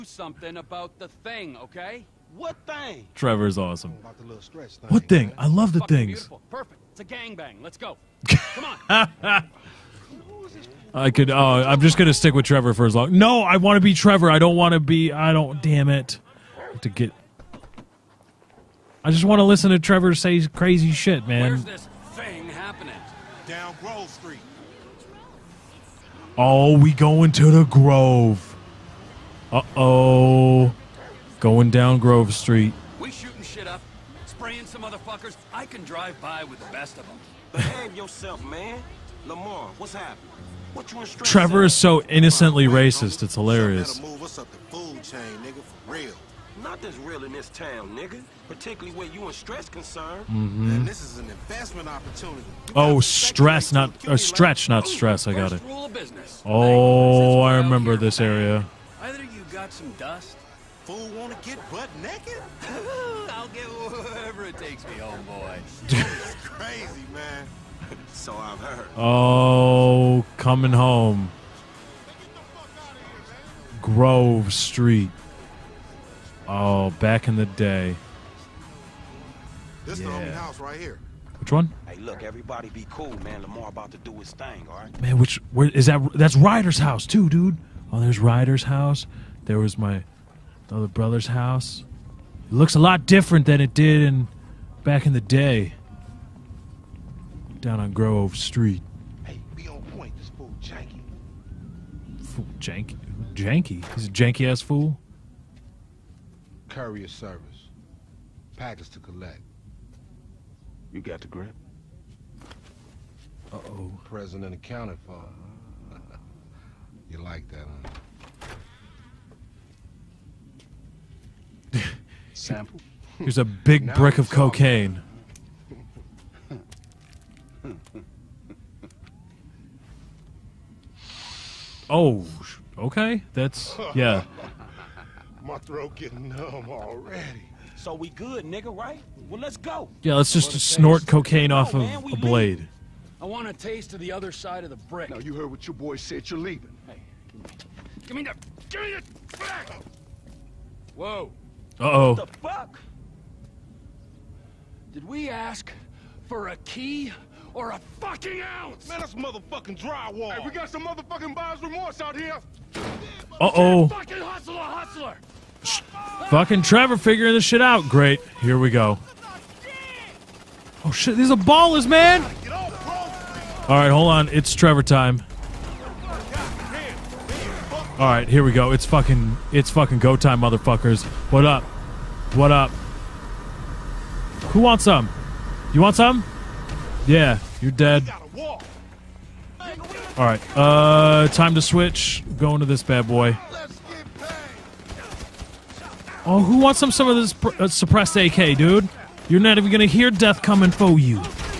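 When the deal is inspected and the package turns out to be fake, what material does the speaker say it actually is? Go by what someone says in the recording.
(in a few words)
Drywall.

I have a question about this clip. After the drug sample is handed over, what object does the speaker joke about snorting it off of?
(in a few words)
A blade.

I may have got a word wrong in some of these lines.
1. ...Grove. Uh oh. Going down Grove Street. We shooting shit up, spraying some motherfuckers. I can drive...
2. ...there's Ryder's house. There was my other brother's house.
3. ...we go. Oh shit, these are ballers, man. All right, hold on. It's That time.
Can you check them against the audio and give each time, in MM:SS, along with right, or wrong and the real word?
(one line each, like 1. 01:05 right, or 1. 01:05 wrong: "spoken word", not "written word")
1. 00:27 right
2. 01:27 right
3. 02:48 wrong: "Trevor", not "That".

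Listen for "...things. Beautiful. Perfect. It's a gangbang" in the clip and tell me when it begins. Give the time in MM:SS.
00:05.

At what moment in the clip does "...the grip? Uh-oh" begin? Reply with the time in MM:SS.
01:51.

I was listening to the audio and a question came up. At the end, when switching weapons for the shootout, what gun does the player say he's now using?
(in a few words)
Suppressed AK.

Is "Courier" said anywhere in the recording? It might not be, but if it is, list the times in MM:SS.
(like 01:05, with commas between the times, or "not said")
01:46.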